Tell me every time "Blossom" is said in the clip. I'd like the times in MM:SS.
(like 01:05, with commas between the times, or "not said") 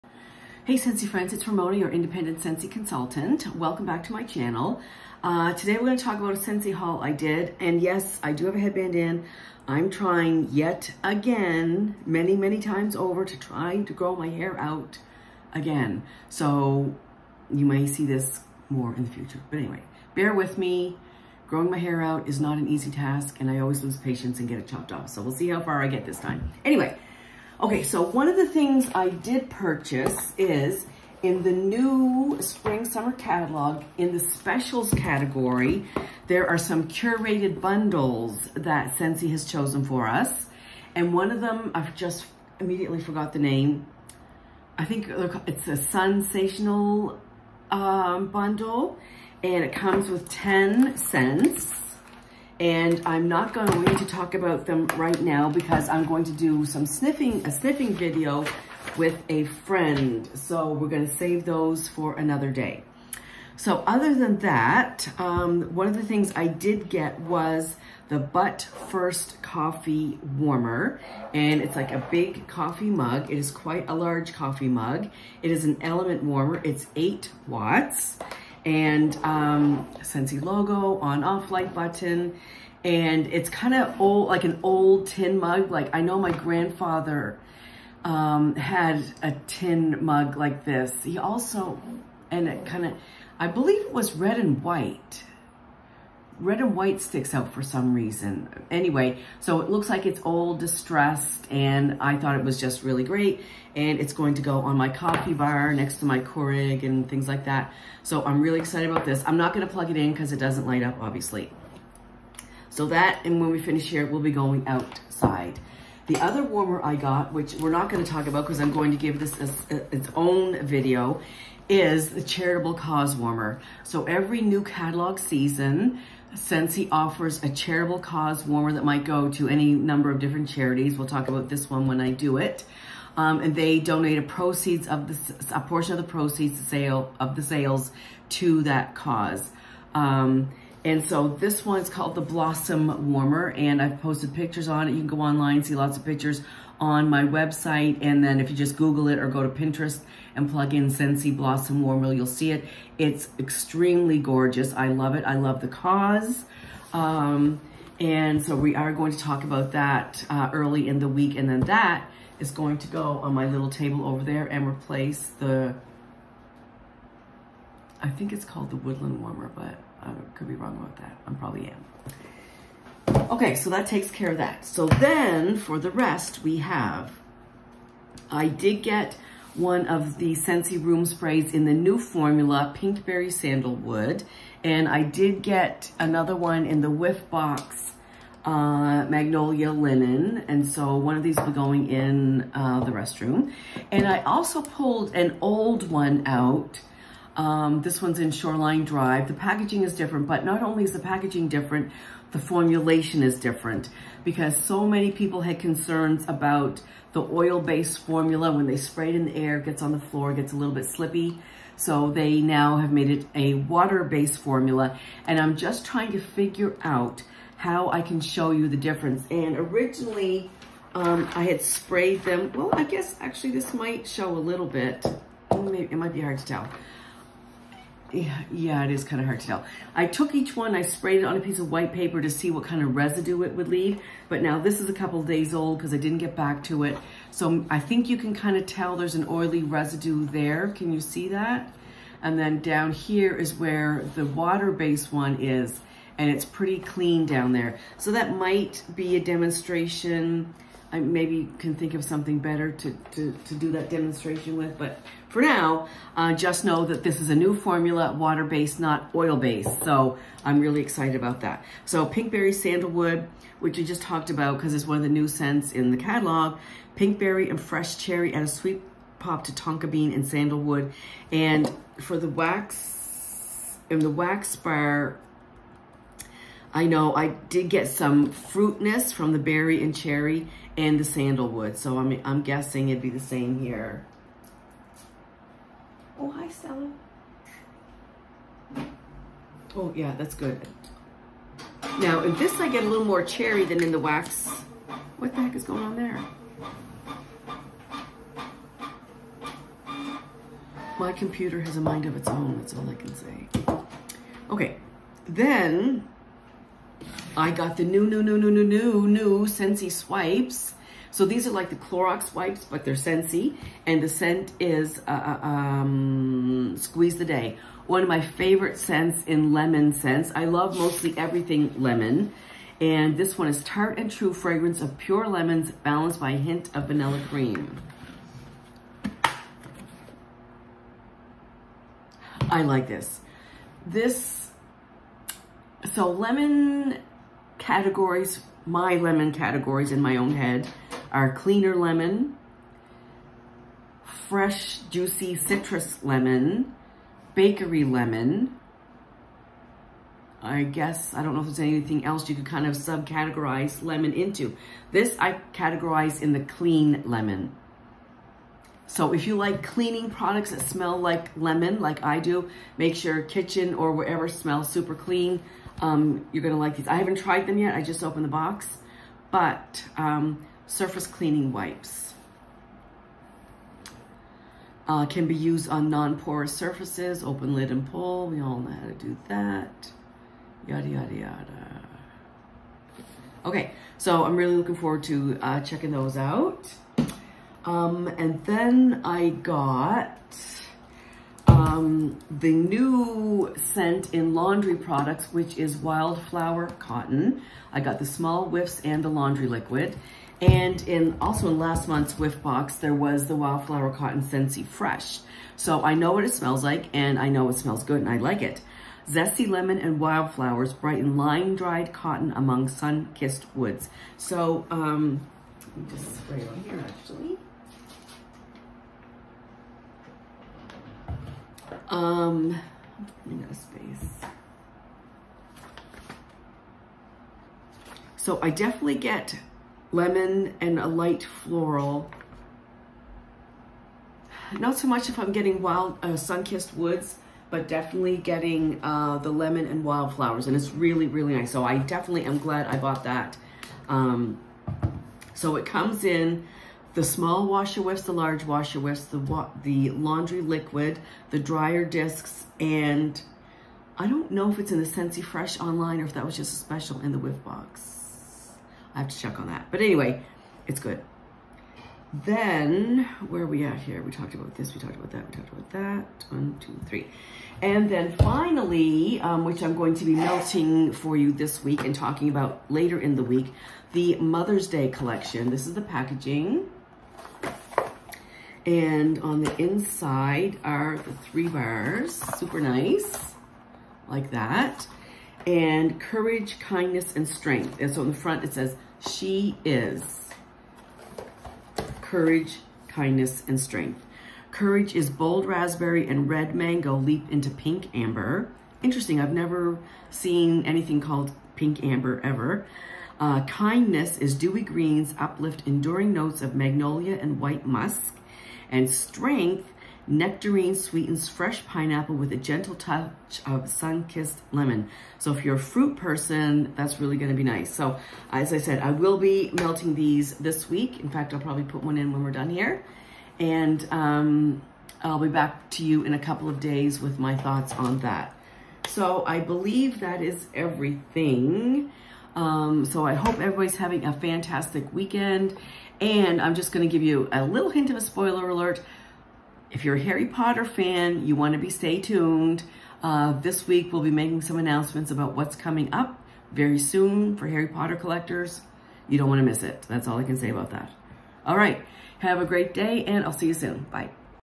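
02:22, 02:31.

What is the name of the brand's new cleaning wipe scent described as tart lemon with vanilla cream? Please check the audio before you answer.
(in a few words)
Squeeze the Day.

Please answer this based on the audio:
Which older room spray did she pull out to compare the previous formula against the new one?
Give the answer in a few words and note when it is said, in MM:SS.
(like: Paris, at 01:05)
Shoreline Drive, at 03:18.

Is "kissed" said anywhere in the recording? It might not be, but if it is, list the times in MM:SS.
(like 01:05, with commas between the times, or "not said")
06:52, 07:16, 08:33.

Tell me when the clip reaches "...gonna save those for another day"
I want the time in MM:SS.
01:00.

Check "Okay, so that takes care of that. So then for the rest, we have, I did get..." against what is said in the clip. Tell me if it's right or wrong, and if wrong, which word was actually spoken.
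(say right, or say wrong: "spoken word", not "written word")
right.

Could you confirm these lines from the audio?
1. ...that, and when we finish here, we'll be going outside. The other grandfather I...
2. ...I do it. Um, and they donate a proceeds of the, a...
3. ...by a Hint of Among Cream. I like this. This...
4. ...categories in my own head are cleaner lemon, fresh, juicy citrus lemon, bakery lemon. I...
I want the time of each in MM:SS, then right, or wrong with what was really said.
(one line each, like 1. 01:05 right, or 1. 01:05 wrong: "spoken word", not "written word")
1. 01:52 wrong: "warmer", not "grandfather"
2. 02:12 right
3. 05:26 wrong: "Vanilla", not "Among"
4. 05:39 right.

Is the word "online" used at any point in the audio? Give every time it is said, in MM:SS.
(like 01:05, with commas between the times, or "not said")
02:25, 07:35.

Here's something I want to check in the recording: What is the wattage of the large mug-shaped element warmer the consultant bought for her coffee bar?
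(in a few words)
8 watts.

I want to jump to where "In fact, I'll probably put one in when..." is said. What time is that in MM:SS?
08:41.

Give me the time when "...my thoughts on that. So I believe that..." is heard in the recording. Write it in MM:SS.
08:47.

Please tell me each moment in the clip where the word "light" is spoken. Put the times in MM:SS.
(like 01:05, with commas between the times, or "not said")
01:21, 01:50, 07:10.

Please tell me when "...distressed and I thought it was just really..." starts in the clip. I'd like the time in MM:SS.
01:40.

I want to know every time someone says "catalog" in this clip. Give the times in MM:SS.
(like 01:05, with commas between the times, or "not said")
00:33, 02:04, 04:25.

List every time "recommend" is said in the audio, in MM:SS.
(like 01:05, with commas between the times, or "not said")
not said.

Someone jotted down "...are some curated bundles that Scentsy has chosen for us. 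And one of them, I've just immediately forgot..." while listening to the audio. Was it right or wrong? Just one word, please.
right.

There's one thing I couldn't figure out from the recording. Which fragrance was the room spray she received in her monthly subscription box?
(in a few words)
Magnolia Linen.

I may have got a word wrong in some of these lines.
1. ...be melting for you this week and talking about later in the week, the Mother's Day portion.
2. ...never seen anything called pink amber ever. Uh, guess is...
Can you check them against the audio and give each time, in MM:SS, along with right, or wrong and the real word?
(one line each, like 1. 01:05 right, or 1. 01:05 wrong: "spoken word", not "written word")
1. 07:50 wrong: "collection", not "portion"
2. 08:19 wrong: "kindness", not "guess".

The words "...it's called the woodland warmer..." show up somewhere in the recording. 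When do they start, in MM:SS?
02:48.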